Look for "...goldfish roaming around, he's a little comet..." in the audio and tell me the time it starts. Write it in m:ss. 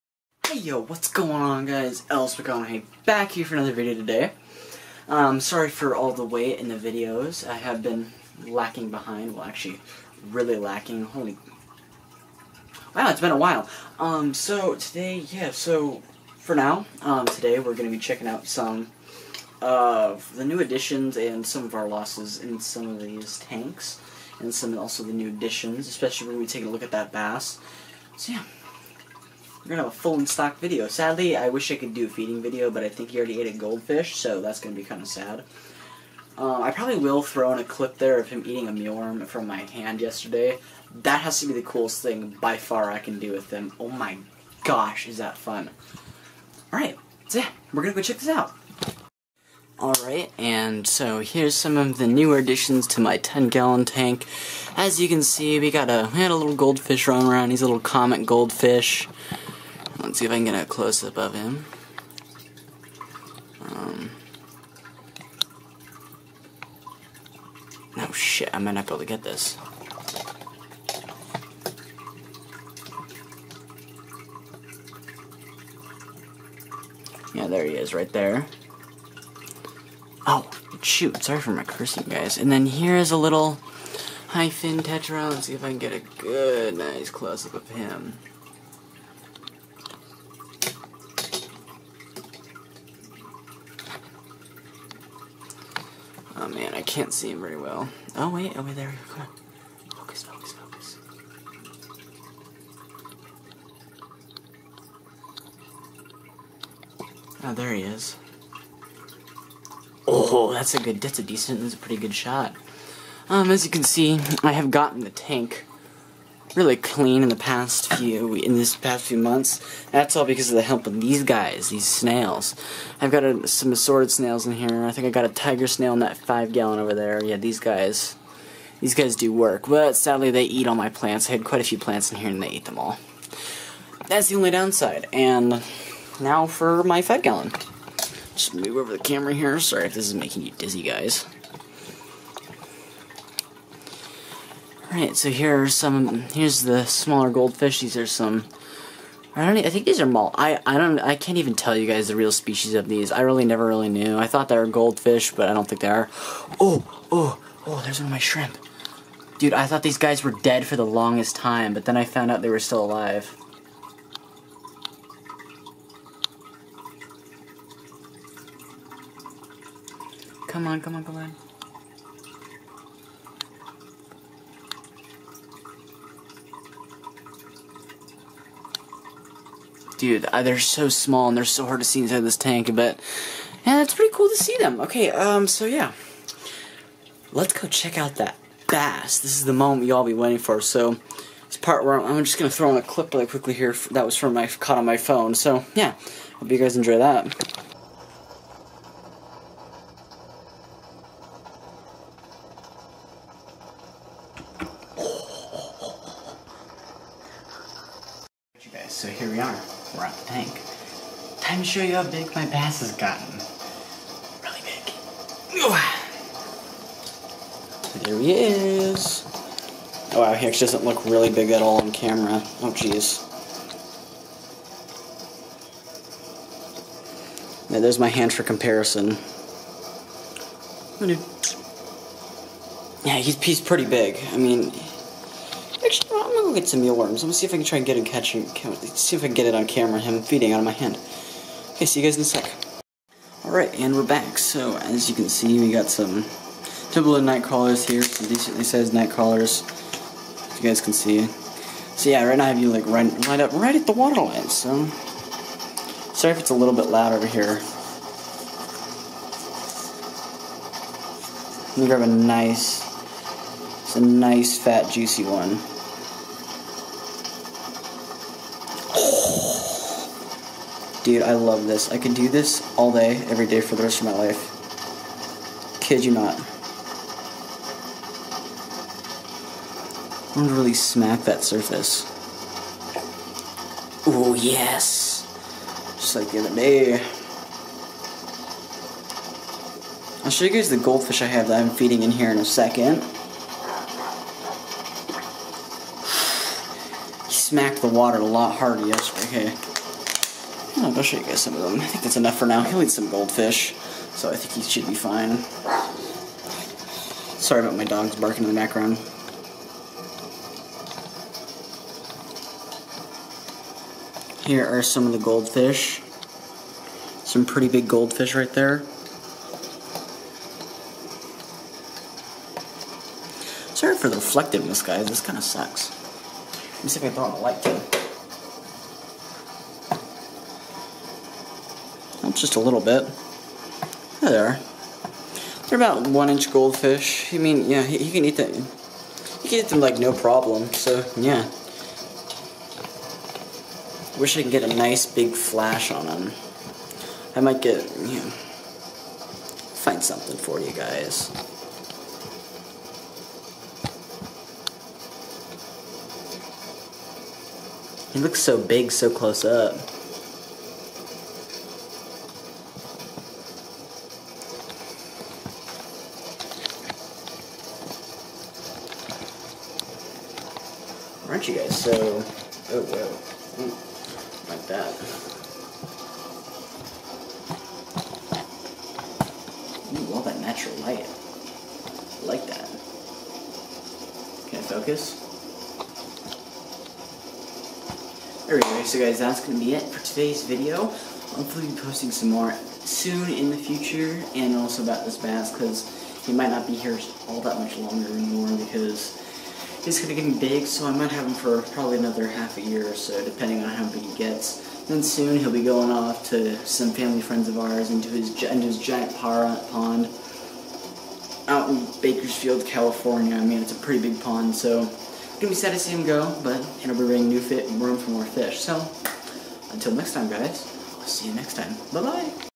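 0:56.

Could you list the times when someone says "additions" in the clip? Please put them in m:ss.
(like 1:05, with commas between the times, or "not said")
0:20, 0:25, 0:52.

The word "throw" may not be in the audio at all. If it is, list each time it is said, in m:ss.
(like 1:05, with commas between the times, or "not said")
0:37, 3:12, 5:27.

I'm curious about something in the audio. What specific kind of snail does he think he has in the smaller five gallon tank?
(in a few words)
tiger snail.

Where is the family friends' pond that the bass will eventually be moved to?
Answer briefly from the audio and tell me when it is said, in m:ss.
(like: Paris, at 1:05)
Bakersfield, California, at 6:51.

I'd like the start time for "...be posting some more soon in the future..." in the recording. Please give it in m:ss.
6:31.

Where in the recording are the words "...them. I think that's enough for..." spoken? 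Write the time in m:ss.
5:01.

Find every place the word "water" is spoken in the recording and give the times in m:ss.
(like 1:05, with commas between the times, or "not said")
4:13, 4:57.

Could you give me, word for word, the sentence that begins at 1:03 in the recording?
Um, oh shit, I might not be able to get this.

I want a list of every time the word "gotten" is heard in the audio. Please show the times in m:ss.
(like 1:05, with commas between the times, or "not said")
1:54, 3:32.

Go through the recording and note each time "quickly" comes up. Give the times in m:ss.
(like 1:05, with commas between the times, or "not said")
3:13.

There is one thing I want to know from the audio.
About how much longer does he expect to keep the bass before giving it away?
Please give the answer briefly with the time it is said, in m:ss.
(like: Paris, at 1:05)
half a year, at 6:42.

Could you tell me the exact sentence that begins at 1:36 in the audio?
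man, I can't see him very well.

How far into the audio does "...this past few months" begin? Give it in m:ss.
1:58.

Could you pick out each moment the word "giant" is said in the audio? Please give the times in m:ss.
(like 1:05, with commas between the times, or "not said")
6:48.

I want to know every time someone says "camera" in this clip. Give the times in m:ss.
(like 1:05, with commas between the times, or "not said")
2:19, 3:41, 3:59.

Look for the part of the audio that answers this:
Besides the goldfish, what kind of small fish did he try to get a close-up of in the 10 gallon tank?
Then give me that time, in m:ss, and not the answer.
1:24.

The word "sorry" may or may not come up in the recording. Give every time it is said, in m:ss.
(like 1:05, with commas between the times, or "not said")
0:05, 1:21, 2:19, 4:16, 5:07, 5:23.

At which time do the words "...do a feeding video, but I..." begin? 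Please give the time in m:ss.
0:31.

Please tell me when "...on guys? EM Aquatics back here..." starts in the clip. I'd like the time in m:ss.
0:01.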